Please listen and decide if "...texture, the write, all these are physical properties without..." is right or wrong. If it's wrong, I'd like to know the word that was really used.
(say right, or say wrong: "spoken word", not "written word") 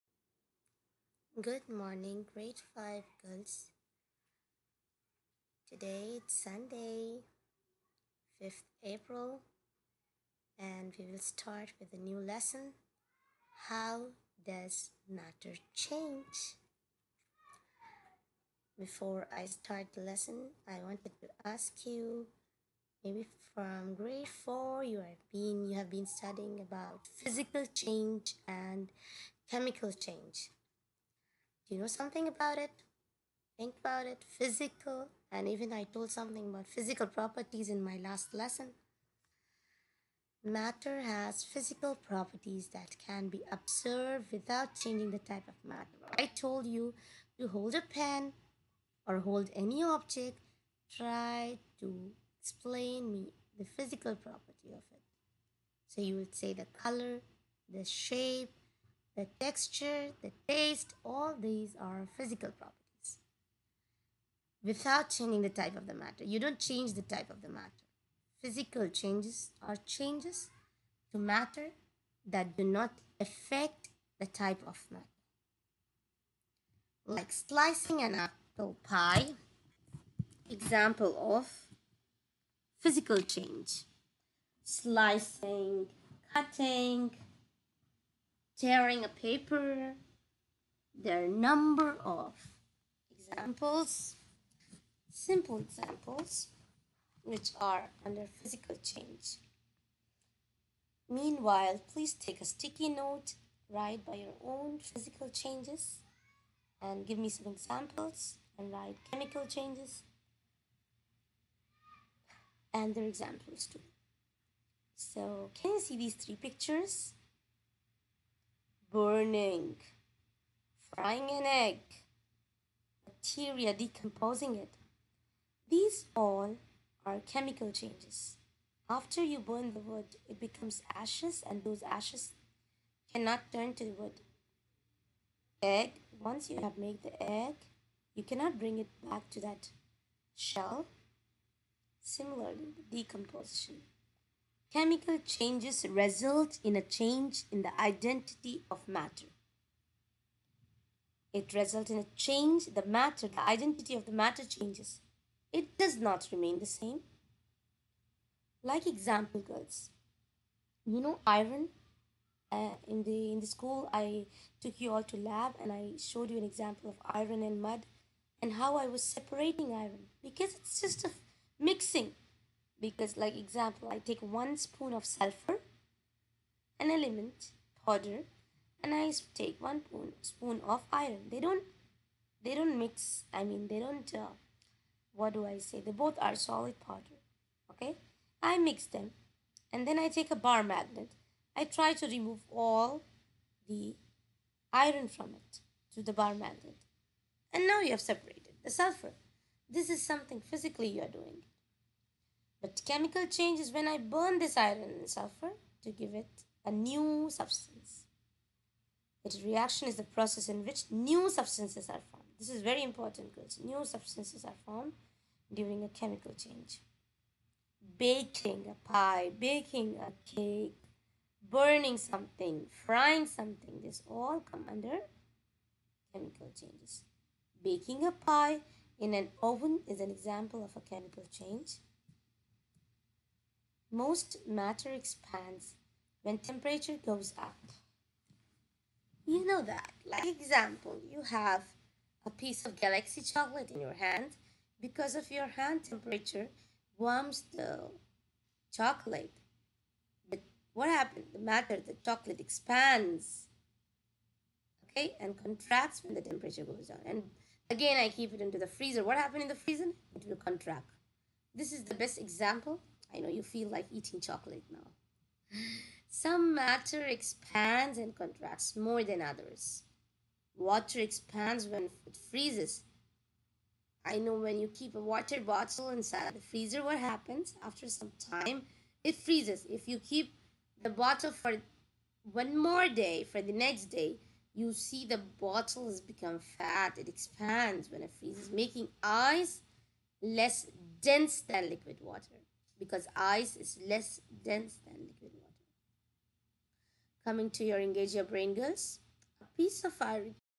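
wrong: "taste", not "write".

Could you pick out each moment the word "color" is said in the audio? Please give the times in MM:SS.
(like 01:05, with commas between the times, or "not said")
00:56.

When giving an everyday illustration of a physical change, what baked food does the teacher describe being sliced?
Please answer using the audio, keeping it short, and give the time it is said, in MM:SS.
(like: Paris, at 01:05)
apple pie, at 01:18.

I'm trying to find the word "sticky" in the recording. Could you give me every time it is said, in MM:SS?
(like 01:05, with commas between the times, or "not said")
01:42.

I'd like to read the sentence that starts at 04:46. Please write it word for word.
It expands when it freezes, making ice less dense than liquid water because ice is less dense than liquid water.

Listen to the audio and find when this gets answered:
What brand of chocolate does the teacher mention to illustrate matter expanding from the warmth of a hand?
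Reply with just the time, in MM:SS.
04:02.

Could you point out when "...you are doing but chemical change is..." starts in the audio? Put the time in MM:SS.
03:20.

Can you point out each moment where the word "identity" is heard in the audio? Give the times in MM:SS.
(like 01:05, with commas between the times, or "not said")
02:27, 02:33.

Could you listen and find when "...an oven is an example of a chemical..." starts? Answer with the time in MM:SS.
03:49.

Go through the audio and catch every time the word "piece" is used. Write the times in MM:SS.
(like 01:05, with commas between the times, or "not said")
04:02, 04:59.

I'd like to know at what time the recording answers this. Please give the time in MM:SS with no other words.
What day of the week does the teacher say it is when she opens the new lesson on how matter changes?
00:06.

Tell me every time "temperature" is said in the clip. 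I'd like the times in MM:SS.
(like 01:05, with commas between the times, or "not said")
03:56, 04:05, 04:16.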